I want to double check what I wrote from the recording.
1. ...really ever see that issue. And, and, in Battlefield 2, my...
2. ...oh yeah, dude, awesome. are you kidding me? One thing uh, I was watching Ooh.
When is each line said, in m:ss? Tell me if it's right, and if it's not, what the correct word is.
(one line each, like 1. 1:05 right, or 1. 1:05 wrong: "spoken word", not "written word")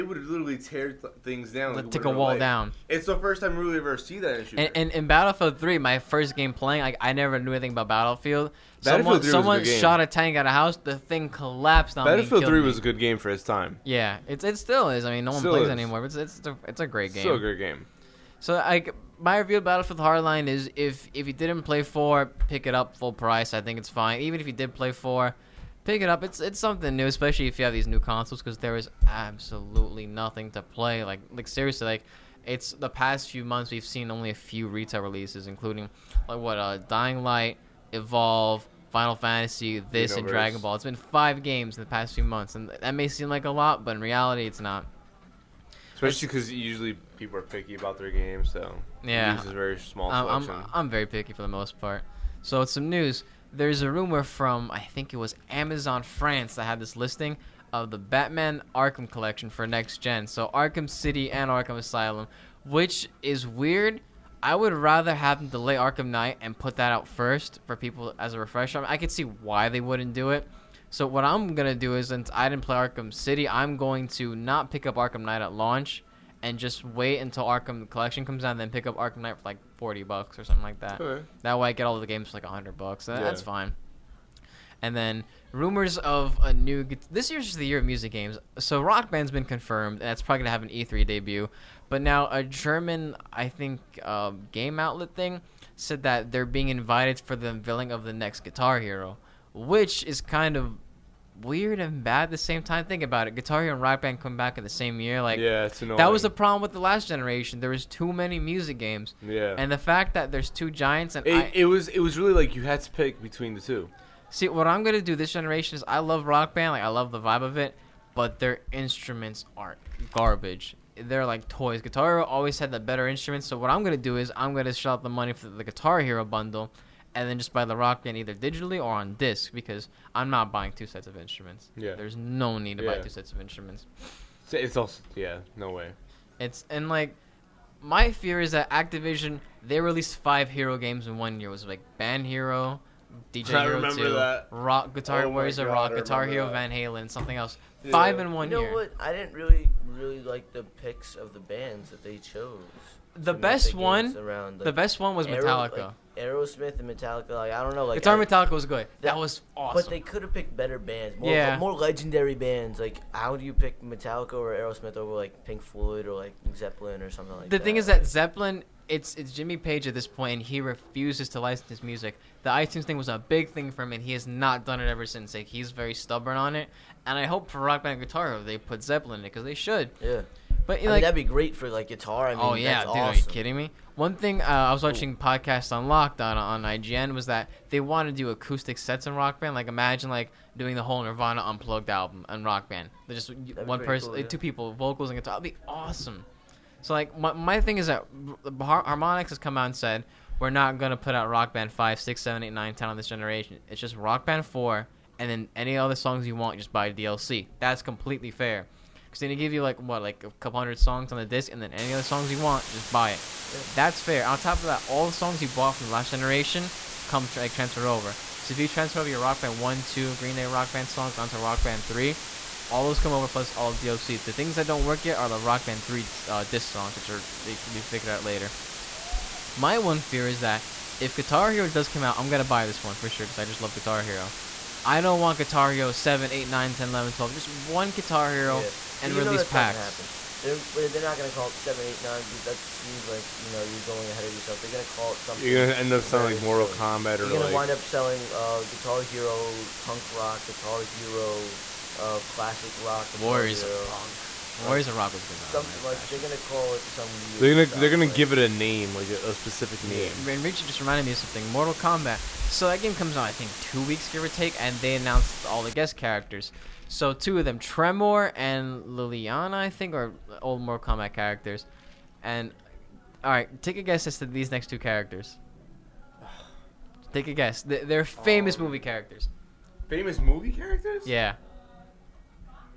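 1. 0:03 wrong: "3", not "2"
2. 3:02 right.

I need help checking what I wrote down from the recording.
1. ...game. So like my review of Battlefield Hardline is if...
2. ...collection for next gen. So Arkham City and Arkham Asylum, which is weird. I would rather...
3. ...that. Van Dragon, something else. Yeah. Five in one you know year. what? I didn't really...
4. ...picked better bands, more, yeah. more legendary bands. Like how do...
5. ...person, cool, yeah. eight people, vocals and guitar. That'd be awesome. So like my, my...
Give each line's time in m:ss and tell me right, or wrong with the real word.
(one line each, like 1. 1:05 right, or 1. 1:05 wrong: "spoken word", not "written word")
1. 0:17 right
2. 0:59 right
3. 2:26 wrong: "Halen", not "Dragon"
4. 2:40 right
5. 3:13 wrong: "two", not "eight".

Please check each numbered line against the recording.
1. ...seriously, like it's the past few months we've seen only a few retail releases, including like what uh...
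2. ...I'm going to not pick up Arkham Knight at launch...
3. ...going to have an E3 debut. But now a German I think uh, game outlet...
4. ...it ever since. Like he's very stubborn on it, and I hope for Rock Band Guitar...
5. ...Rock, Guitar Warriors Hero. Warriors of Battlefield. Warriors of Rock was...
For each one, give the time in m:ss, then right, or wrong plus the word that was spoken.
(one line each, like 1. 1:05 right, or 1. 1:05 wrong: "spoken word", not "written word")
1. 0:31 right
2. 1:13 right
3. 1:30 right
4. 2:54 right
5. 4:12 wrong: "Punk", not "Battlefield".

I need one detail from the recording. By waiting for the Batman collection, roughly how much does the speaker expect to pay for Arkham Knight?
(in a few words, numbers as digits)
$40.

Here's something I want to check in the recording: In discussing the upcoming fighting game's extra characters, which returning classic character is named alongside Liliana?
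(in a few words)
Tremor.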